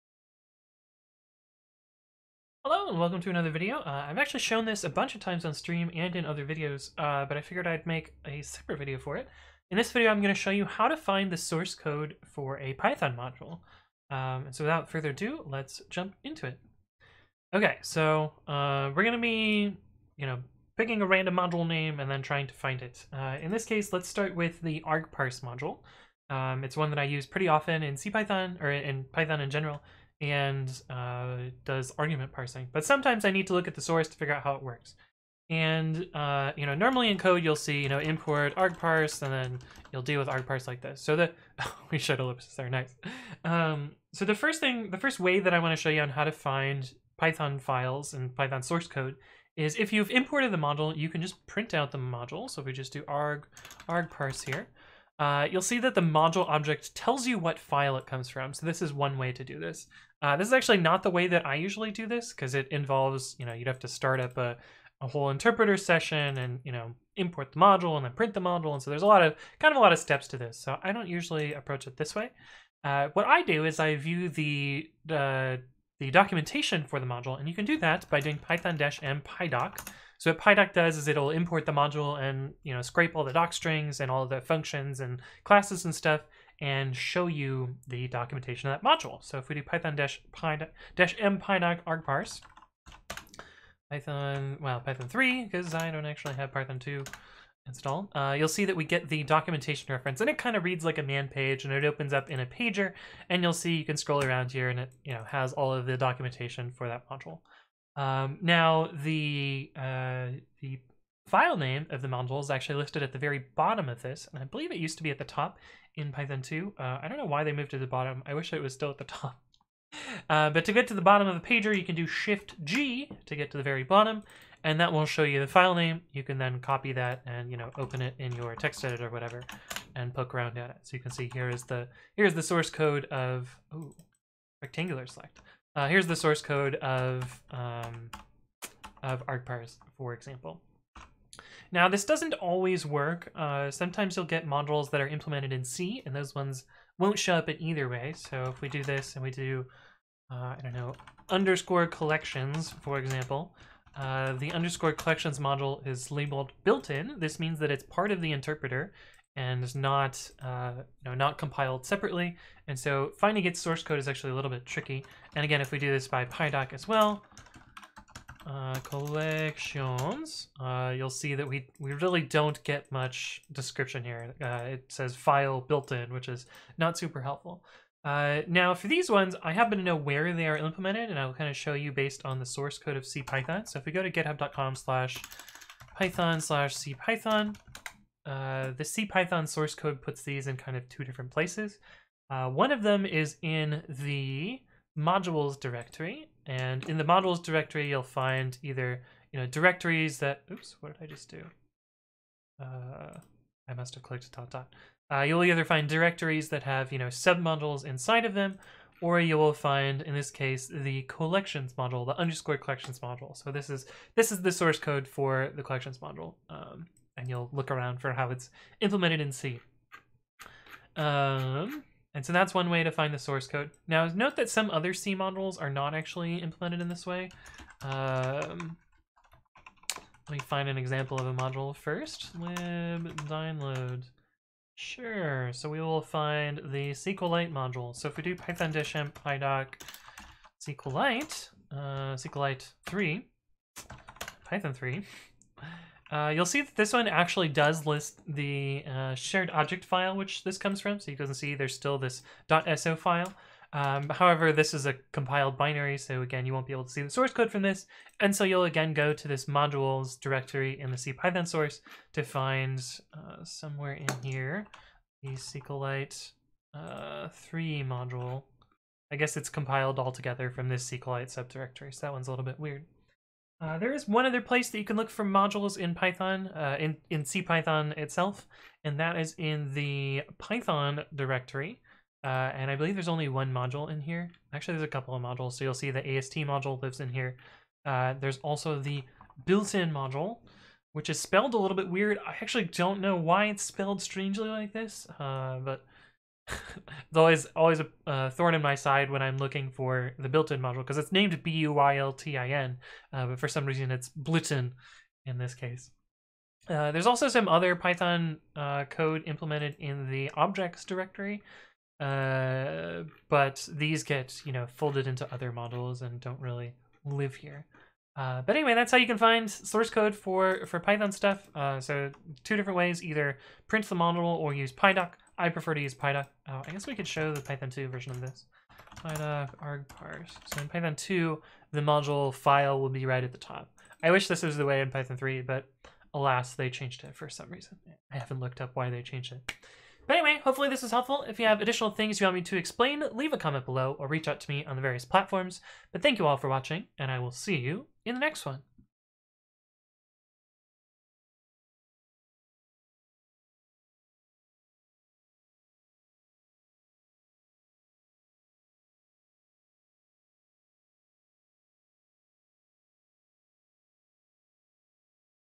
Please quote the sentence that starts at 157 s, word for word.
This means that it's part of the interpreter, and not uh, you know not compiled separately.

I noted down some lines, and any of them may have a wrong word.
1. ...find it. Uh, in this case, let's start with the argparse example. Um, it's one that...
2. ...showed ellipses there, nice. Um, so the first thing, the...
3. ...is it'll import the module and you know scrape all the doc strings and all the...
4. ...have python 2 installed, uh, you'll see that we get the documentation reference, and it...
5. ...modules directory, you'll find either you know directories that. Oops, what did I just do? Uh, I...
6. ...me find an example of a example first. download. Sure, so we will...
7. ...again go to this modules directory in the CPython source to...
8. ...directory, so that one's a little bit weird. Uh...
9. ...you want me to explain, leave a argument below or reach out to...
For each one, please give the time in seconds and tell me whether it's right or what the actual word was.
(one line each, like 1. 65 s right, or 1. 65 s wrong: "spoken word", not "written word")
1. 22 s wrong: "module", not "example"
2. 41 s right
3. 80 s right
4. 96 s right
5. 197 s right
6. 230 s wrong: "module", not "example"
7. 258 s right
8. 271 s wrong: "subdirectory", not "directory"
9. 342 s wrong: "comment", not "argument".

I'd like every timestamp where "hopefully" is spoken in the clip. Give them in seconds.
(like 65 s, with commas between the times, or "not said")
340 s.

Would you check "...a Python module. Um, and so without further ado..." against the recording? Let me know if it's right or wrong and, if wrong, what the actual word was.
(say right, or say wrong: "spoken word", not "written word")
right.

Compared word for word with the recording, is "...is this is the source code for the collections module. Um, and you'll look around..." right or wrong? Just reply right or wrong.
right.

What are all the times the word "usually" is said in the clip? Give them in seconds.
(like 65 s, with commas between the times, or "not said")
61 s, 71 s.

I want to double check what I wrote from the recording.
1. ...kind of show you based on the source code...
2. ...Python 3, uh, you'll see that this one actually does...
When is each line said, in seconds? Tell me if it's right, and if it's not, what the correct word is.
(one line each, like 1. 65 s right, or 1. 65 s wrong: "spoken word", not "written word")
1. 181 s right
2. 244 s right.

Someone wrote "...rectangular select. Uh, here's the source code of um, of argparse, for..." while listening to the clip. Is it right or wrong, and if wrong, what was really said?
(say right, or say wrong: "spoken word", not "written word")
right.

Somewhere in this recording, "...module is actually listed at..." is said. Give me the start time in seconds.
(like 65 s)
112 s.